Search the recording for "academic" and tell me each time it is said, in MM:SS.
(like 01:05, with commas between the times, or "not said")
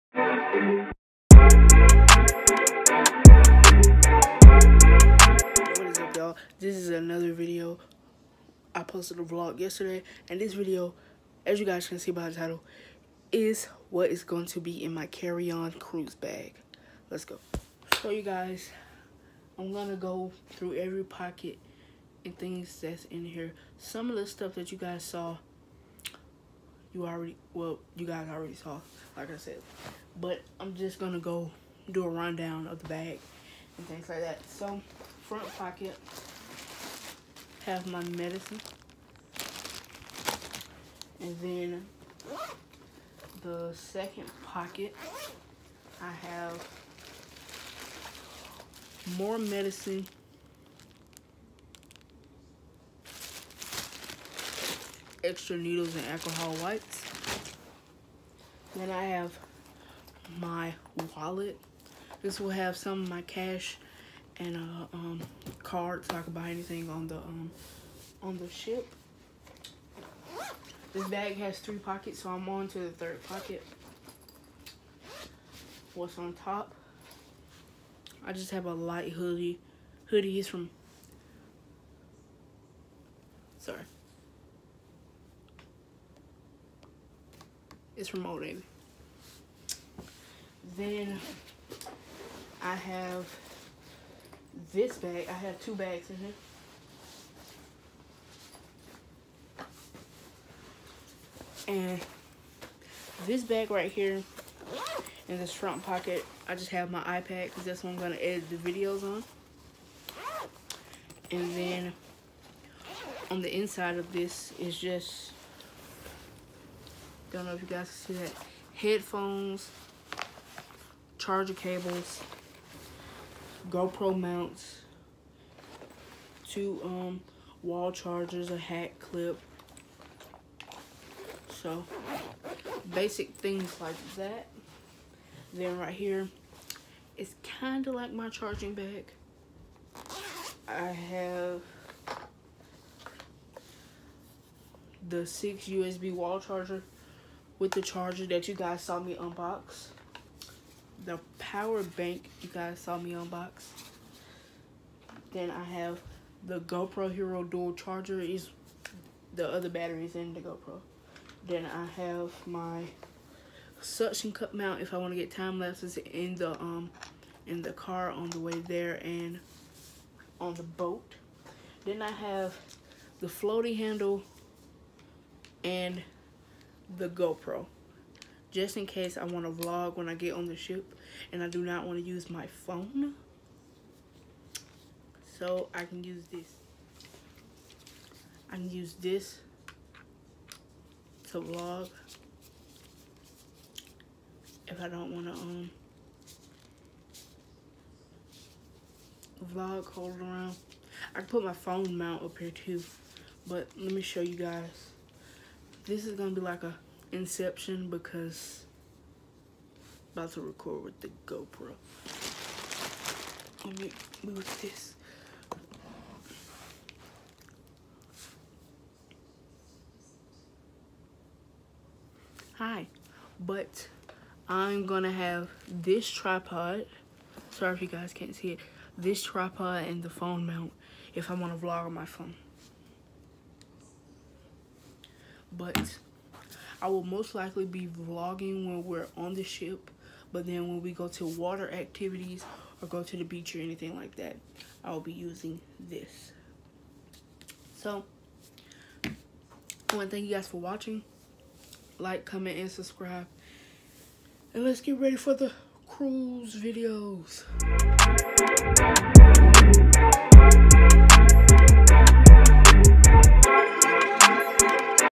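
not said.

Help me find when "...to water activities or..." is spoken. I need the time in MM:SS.
04:01.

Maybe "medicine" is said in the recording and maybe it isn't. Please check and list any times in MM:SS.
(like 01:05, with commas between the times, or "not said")
00:38, 00:49.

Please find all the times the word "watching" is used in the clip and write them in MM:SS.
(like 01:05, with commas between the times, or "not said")
04:10.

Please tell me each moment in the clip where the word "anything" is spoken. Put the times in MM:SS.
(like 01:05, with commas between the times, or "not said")
01:06, 04:03.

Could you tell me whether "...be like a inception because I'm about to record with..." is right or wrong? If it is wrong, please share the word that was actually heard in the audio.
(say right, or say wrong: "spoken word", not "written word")
right.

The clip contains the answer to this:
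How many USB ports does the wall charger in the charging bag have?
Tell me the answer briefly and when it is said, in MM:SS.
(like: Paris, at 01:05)
6, at 02:25.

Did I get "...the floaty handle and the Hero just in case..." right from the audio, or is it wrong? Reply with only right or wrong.
wrong.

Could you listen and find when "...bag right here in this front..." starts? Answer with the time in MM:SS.
01:43.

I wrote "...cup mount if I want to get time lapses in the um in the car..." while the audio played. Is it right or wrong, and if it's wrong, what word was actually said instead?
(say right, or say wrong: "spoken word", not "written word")
right.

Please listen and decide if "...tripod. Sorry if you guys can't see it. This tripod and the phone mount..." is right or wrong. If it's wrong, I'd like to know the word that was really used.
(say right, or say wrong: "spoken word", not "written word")
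right.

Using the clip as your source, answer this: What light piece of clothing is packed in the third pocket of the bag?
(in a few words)
hoodie.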